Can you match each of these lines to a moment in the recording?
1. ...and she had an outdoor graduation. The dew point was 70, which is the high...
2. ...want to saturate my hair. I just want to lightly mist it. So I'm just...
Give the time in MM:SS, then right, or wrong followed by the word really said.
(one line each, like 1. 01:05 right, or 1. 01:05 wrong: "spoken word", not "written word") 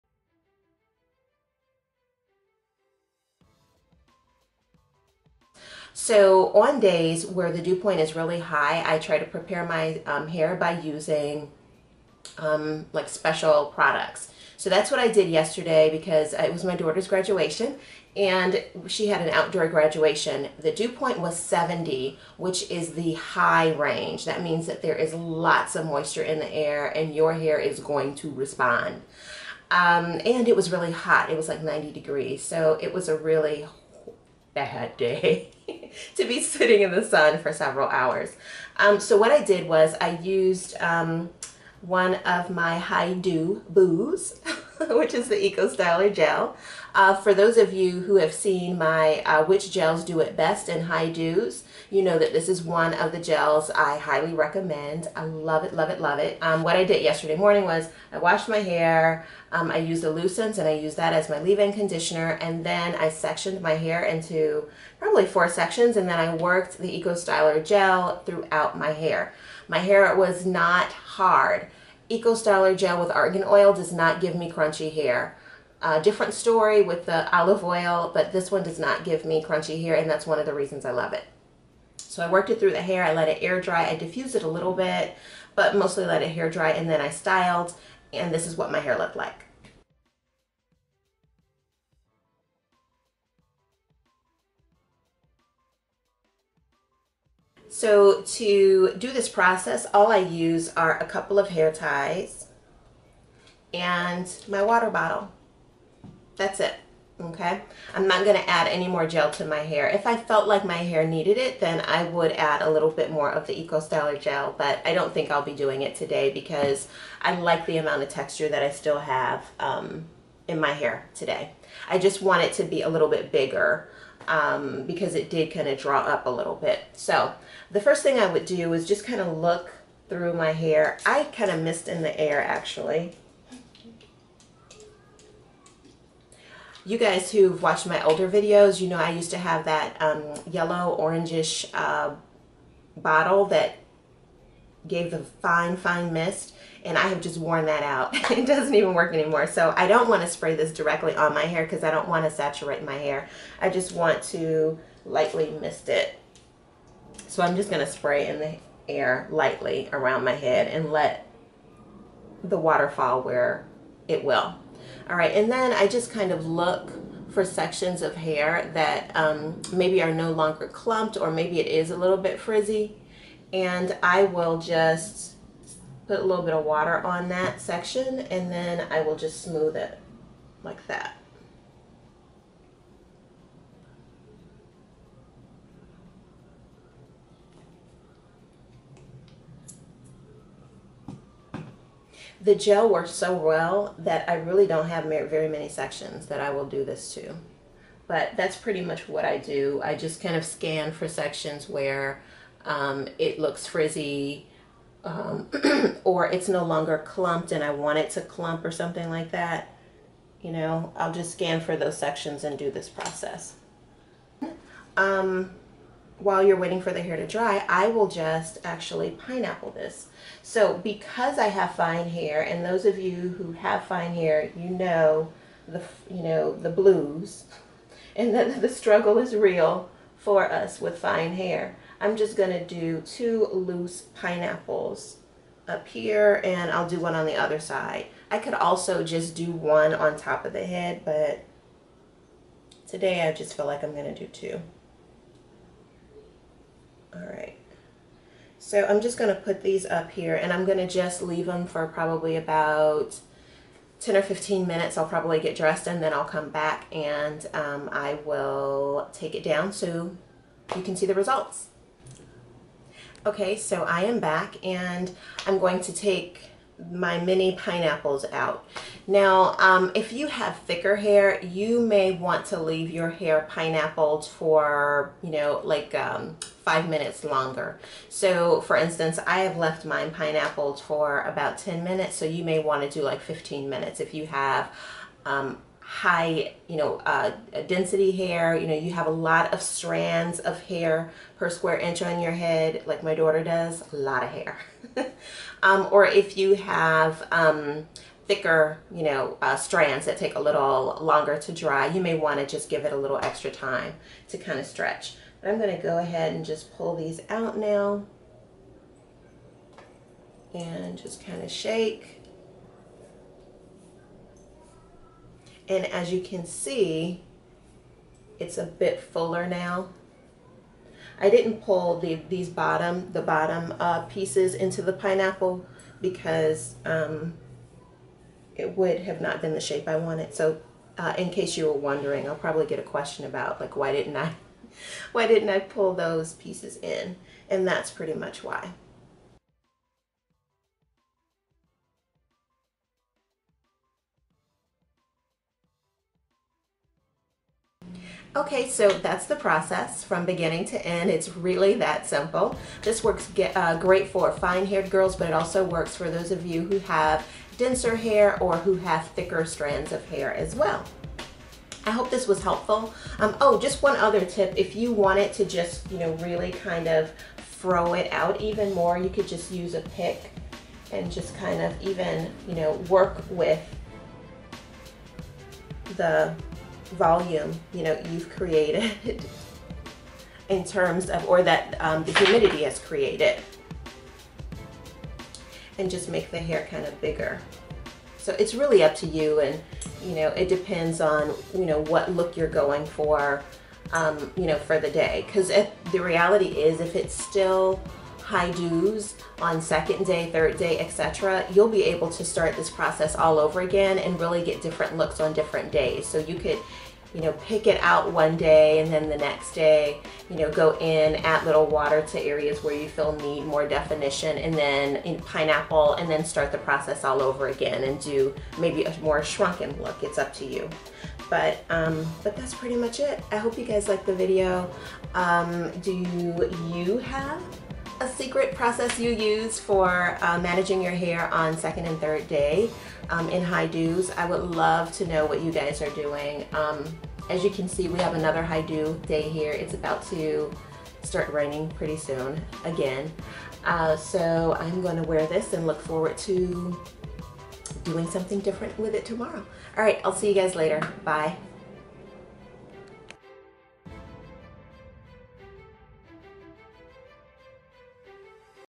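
1. 00:18 right
2. 02:32 right.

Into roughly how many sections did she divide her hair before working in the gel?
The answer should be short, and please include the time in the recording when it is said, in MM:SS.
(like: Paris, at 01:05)
4, at 01:05.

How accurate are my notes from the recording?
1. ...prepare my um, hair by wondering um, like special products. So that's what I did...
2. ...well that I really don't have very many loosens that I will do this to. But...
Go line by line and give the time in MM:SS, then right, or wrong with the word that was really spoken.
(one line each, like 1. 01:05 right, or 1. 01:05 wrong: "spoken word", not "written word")
1. 00:09 wrong: "using", not "wondering"
2. 03:13 wrong: "sections", not "loosens".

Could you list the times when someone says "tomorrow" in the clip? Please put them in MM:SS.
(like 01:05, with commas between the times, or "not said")
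07:29.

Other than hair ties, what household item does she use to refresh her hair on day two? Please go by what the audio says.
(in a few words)
Water bottle.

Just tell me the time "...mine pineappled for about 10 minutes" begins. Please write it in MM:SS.
04:39.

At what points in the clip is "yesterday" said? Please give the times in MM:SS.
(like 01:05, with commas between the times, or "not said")
00:15, 00:57.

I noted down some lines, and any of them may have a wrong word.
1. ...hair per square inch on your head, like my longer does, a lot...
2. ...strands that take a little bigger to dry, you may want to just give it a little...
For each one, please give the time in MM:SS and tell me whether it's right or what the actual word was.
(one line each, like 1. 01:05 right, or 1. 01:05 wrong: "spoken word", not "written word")
1. 04:50 wrong: "daughter", not "longer"
2. 04:59 wrong: "longer", not "bigger".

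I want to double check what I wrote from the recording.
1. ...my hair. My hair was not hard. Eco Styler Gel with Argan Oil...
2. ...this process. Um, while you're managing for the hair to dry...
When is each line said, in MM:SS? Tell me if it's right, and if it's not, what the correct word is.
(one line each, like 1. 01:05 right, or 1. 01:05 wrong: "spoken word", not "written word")
1. 01:08 right
2. 03:32 wrong: "waiting", not "managing".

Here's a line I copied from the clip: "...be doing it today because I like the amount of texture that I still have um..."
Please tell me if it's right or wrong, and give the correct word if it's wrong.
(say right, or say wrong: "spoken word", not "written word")
right.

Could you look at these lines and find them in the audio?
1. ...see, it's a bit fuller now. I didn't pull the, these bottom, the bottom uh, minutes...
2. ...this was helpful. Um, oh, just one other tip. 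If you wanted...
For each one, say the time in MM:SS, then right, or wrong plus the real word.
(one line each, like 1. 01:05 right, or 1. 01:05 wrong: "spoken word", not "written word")
1. 05:16 wrong: "pieces", not "minutes"
2. 06:02 right.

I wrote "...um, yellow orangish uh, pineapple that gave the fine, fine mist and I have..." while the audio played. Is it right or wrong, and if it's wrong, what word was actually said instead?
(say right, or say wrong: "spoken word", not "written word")
wrong: "bottle", not "pineapple".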